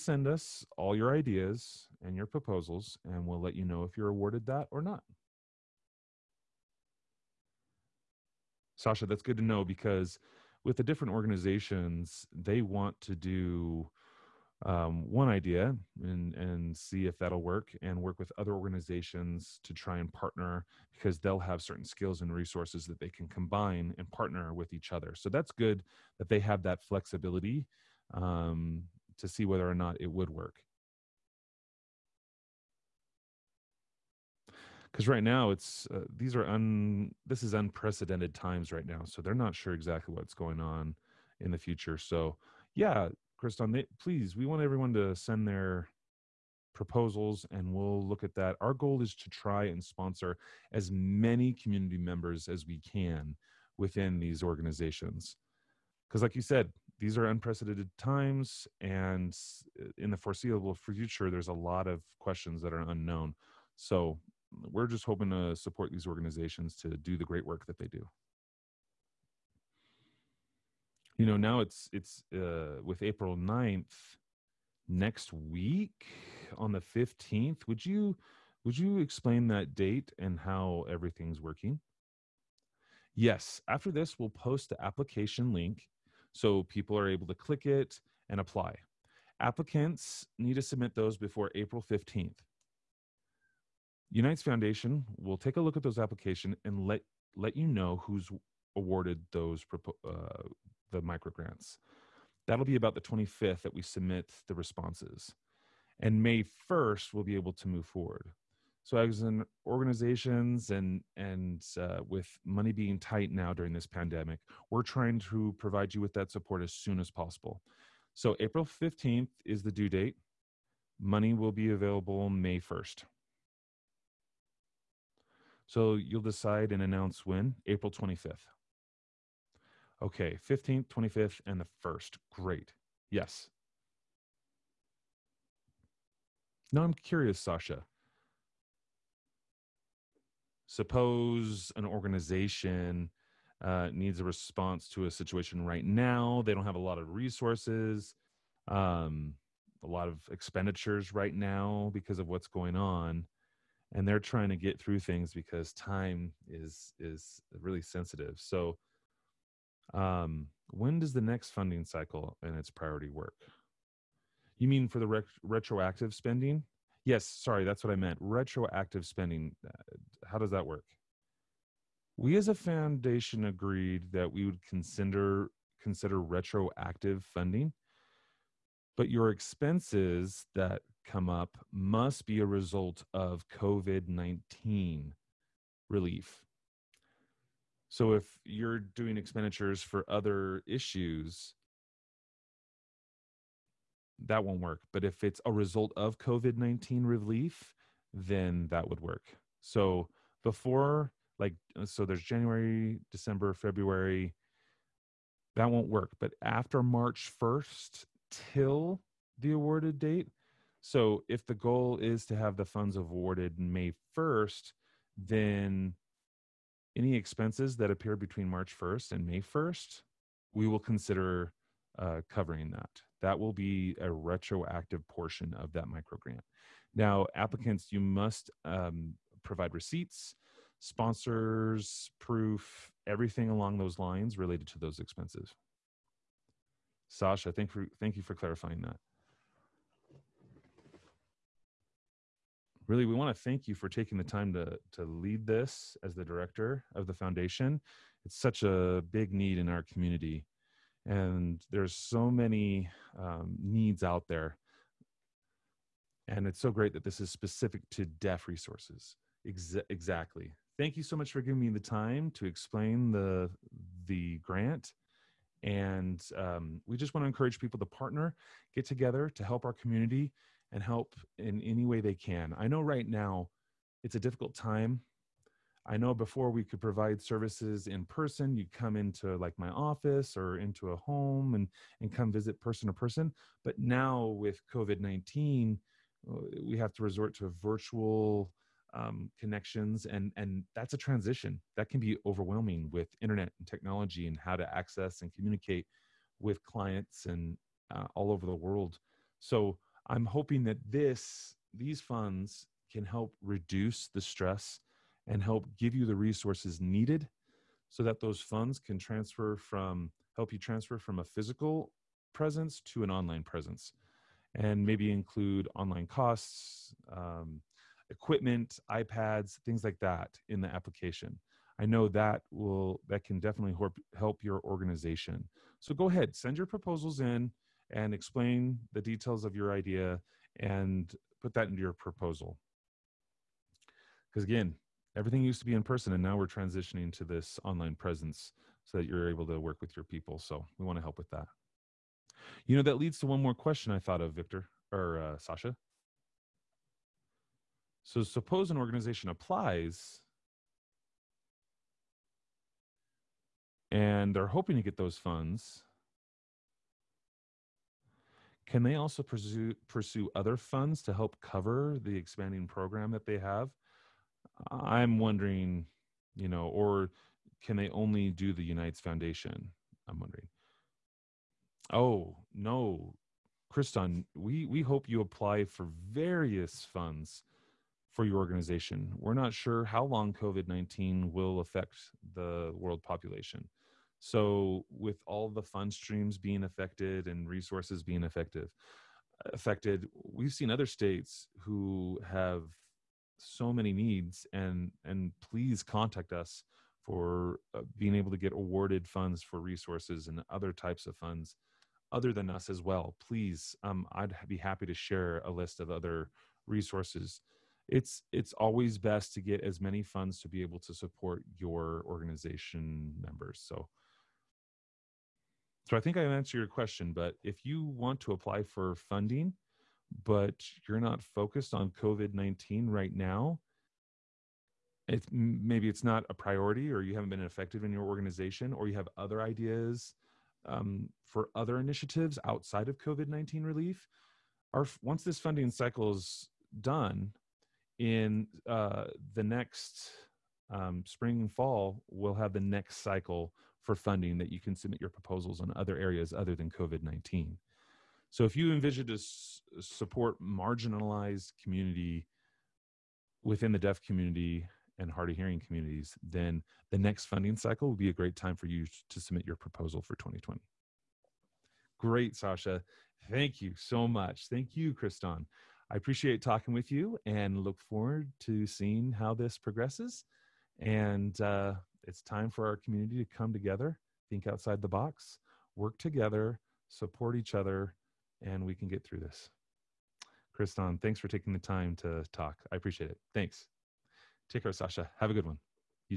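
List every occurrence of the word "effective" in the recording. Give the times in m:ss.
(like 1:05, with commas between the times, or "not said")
6:28, 7:07.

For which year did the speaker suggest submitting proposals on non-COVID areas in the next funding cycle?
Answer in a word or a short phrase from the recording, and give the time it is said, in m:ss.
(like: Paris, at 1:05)
2020, at 7:40.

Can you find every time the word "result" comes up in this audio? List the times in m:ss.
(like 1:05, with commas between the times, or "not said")
3:02, 3:15.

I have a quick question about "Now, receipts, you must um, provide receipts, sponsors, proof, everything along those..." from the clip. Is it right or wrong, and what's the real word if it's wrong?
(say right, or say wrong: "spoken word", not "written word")
wrong: "applicants", not "receipts".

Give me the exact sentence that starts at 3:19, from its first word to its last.
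So before, like, uh, so there's January, December, February, that won't work.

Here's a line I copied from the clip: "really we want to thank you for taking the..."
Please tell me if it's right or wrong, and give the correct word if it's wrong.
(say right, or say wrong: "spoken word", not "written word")
right.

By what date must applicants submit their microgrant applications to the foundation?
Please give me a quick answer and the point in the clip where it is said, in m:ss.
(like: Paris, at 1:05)
April 15, at 1:31.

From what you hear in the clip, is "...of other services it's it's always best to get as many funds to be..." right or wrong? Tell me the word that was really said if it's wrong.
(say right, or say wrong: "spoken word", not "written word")
wrong: "resources", not "services".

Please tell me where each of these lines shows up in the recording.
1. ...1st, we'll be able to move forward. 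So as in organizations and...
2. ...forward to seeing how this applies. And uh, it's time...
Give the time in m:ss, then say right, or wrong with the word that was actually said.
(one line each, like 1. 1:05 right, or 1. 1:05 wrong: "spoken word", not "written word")
1. 1:46 right
2. 7:47 wrong: "progresses", not "applies".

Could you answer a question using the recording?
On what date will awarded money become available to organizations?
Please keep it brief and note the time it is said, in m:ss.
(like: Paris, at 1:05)
May 1, at 2:00.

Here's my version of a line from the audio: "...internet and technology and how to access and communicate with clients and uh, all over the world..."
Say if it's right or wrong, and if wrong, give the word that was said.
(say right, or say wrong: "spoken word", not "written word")
right.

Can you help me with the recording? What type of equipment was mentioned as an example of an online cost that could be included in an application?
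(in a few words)
iPads.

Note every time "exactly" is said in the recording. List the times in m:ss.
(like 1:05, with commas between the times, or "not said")
0:39, 4:19.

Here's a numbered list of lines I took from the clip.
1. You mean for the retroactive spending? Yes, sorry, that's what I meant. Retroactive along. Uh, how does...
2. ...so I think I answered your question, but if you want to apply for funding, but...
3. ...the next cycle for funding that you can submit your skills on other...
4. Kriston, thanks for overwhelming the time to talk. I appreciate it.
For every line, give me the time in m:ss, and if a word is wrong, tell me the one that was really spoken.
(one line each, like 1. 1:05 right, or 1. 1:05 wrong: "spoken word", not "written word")
1. 2:44 wrong: "spending", not "along"
2. 6:55 right
3. 7:22 wrong: "proposals", not "skills"
4. 8:00 wrong: "taking", not "overwhelming".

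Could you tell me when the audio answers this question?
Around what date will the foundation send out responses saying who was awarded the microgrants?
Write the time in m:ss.
1:42.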